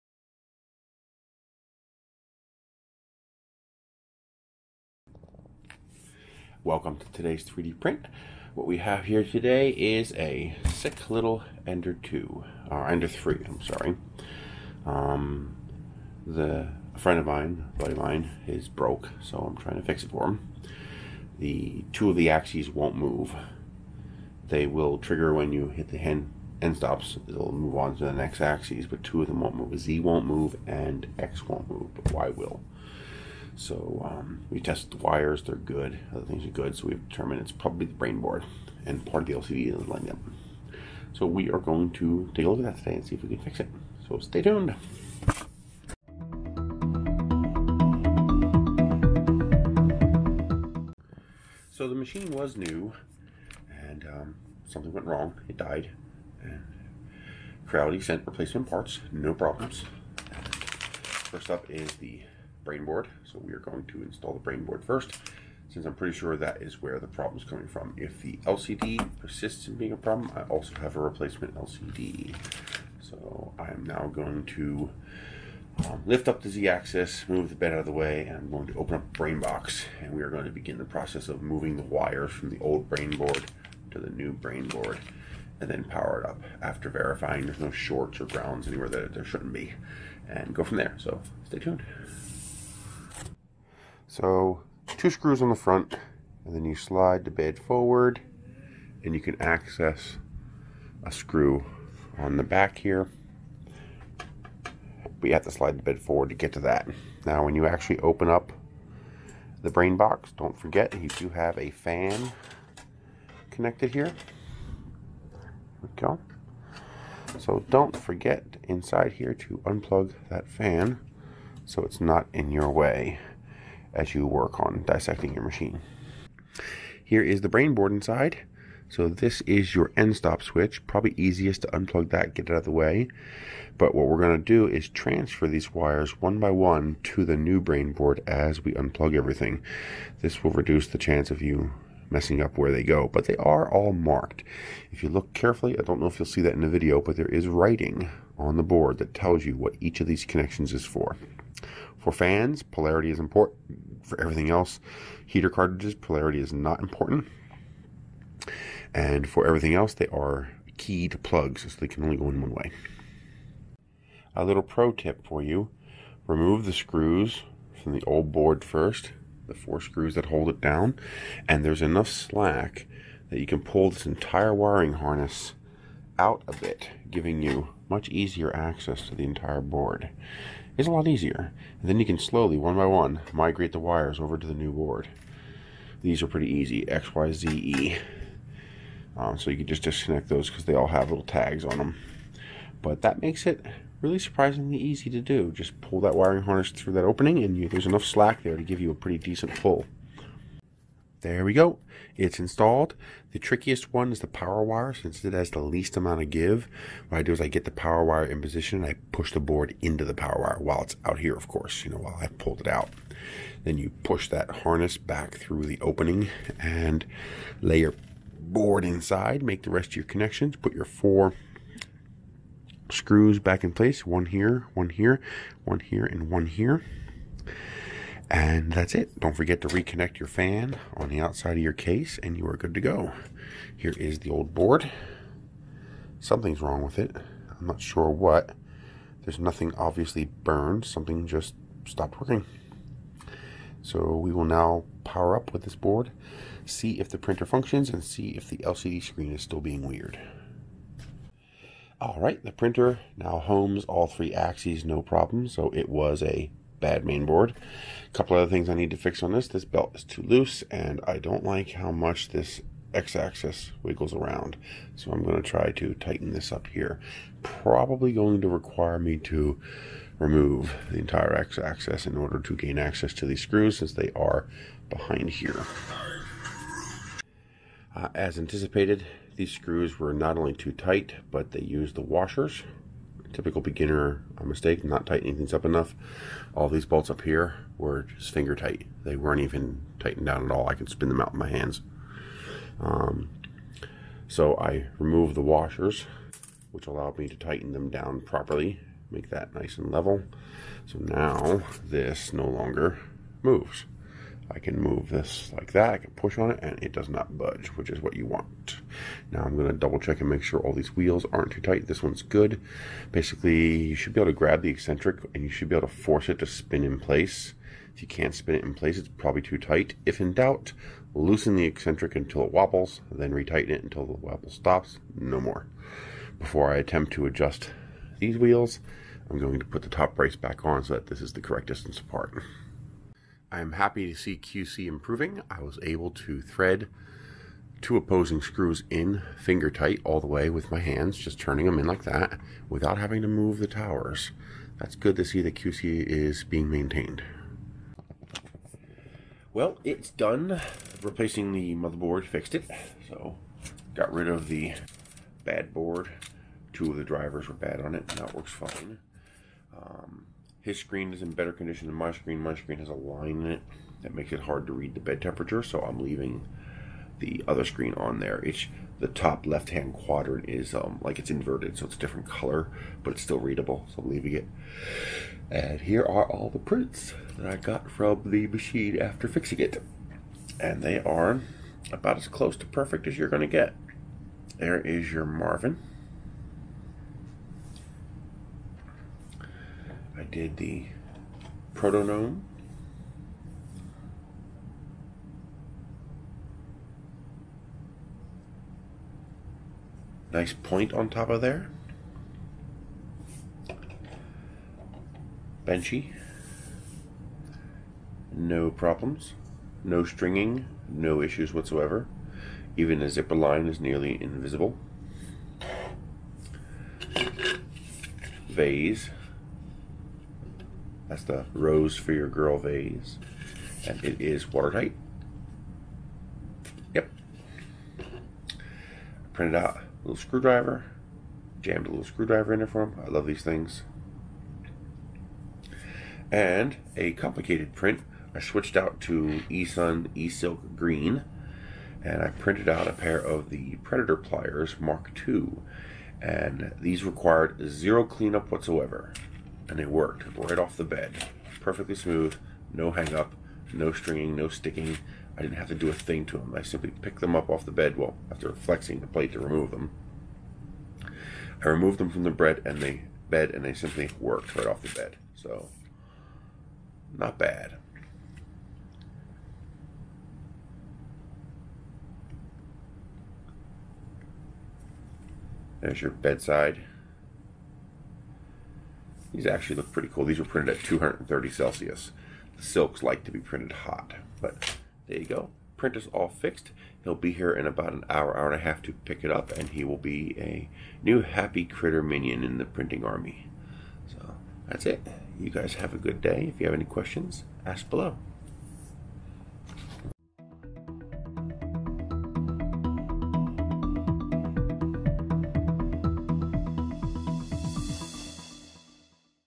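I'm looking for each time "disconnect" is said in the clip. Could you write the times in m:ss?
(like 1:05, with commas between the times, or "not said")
3:09.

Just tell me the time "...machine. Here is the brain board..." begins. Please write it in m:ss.
2:05.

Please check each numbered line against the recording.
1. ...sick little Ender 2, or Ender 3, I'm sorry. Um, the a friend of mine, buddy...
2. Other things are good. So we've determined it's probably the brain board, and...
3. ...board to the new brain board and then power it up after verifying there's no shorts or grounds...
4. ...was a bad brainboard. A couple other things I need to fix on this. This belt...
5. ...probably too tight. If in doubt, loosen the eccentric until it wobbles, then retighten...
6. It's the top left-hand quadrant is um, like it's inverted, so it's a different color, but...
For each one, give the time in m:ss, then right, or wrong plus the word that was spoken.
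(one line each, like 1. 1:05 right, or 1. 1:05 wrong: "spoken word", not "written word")
1. 0:10 right
2. 0:36 right
3. 1:23 right
4. 4:15 wrong: "mainboard", not "brainboard"
5. 5:19 right
6. 6:08 right.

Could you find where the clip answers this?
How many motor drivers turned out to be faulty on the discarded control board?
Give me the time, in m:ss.
5:56.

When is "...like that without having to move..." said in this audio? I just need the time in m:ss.
5:41.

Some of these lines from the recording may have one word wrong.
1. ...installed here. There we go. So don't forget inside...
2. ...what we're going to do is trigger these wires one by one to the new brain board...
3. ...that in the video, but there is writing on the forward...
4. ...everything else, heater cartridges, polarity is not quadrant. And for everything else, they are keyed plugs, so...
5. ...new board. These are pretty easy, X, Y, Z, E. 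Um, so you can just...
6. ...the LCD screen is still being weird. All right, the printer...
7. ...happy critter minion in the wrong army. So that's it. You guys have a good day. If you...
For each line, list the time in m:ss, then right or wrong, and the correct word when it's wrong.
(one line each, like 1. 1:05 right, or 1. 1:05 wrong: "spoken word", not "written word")
1. 1:53 wrong: "connected", not "installed"
2. 2:13 wrong: "transfer", not "trigger"
3. 2:26 wrong: "board", not "forward"
4. 2:34 wrong: "important", not "quadrant"
5. 3:04 right
6. 4:08 right
7. 8:11 wrong: "printing", not "wrong".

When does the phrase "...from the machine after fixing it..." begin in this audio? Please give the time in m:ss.
6:17.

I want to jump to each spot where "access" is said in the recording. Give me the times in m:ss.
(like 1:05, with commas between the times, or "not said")
1:39, 2:58, 4:32.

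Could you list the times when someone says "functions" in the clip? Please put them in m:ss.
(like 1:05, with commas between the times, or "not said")
4:07.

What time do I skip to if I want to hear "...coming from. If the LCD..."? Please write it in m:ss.
1:07.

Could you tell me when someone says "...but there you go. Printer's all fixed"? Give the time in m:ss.
8:04.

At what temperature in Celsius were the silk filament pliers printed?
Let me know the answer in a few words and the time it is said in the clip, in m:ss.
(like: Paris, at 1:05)
230, at 8:00.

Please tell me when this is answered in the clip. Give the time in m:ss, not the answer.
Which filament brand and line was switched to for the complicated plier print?
7:19.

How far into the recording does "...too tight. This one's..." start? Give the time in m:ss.
5:11.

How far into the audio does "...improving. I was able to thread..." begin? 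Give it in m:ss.
5:34.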